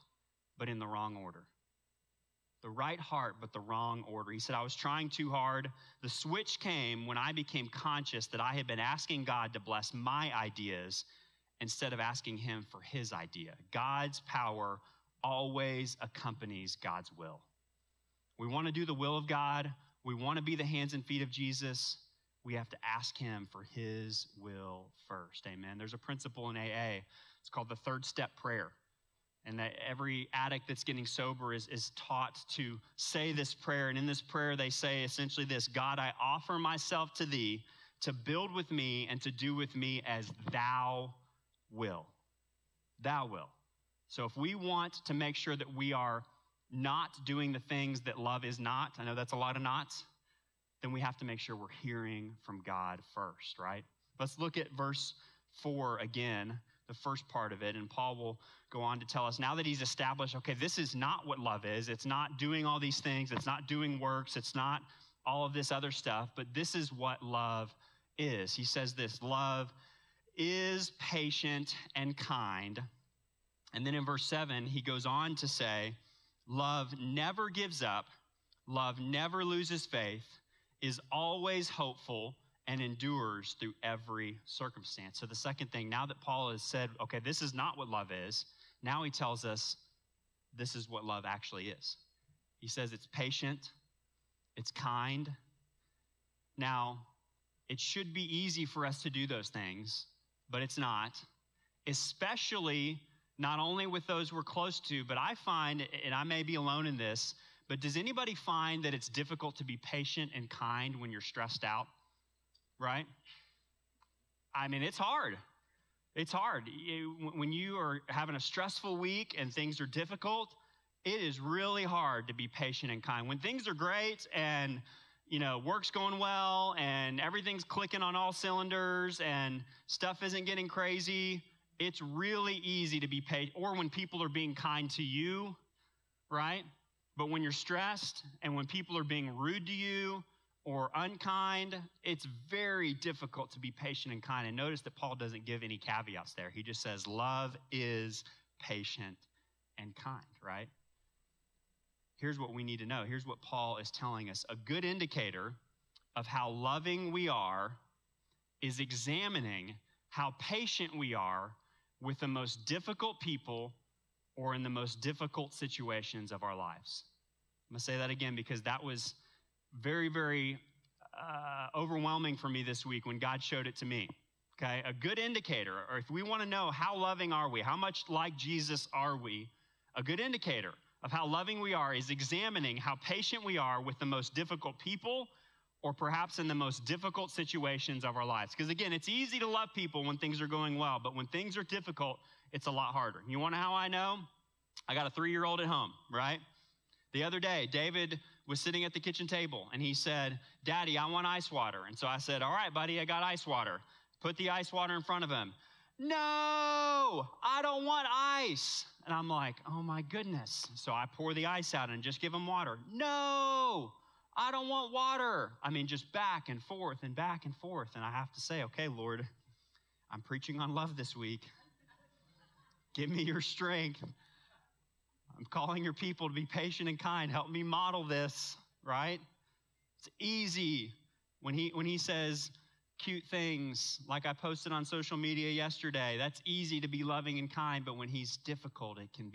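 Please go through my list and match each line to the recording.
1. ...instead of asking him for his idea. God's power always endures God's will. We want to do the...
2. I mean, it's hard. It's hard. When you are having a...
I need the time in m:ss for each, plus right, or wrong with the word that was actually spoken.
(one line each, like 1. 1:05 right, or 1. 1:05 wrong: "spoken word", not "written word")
1. 0:11 wrong: "accompanies", not "endures"
2. 1:54 right.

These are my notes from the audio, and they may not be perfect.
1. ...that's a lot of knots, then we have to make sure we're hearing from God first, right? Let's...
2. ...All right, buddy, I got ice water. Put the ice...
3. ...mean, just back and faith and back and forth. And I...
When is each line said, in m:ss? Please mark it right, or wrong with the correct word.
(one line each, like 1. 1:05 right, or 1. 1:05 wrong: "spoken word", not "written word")
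1. 0:49 right
2. 3:22 right
3. 3:35 wrong: "forth", not "faith".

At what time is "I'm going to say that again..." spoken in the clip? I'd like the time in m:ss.
2:47.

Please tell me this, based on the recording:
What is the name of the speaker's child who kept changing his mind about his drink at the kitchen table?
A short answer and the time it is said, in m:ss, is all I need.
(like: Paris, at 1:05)
David, at 3:17.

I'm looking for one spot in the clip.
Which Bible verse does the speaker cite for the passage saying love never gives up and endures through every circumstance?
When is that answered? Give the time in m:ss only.
1:14.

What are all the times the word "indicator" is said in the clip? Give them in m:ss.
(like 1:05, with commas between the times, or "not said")
2:34, 2:55, 3:00.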